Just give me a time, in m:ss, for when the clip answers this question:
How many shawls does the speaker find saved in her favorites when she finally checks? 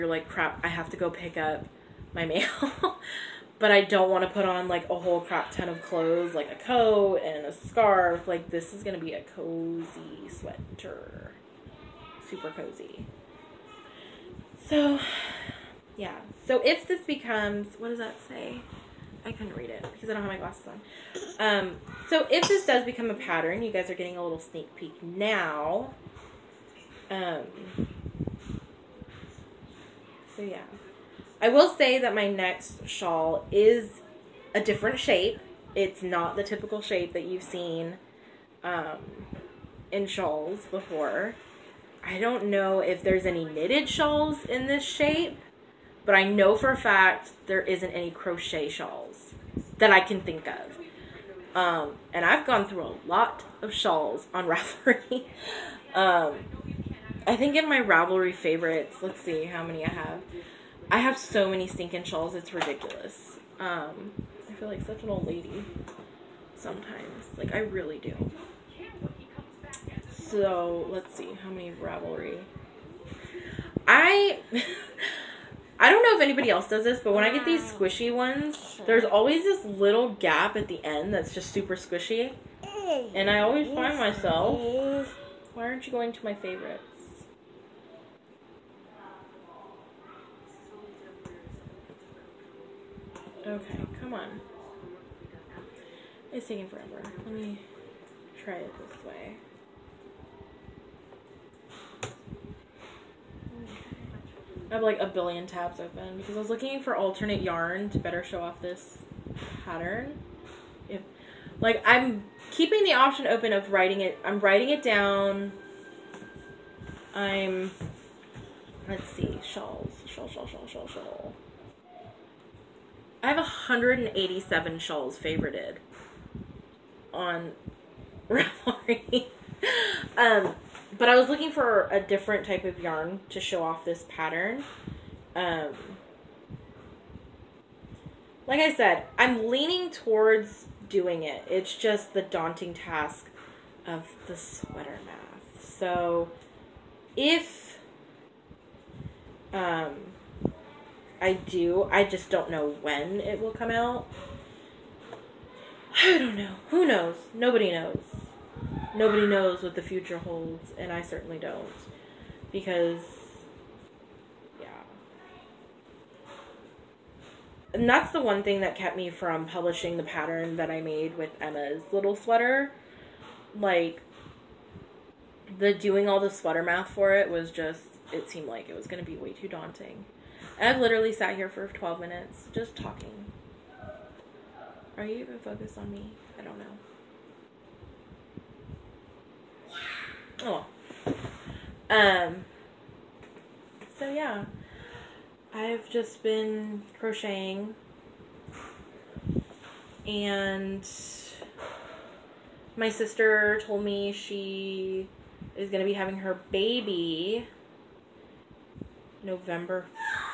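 2:03.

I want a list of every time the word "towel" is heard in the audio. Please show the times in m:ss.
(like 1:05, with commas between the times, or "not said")
not said.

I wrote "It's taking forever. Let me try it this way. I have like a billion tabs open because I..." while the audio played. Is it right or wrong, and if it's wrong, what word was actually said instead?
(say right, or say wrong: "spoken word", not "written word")
right.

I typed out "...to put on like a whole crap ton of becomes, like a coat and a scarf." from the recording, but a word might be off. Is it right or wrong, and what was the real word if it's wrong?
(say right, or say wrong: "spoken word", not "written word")
wrong: "clothes", not "becomes".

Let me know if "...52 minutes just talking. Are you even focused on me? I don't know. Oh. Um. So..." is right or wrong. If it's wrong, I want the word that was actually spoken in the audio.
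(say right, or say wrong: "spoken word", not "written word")
wrong: "12", not "52".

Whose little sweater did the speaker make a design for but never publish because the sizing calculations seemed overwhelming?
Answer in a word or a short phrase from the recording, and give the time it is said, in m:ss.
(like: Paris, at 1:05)
Emma, at 2:51.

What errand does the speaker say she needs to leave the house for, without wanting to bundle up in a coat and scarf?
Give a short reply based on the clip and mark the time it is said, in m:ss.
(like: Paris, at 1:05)
pick up my mail, at 0:01.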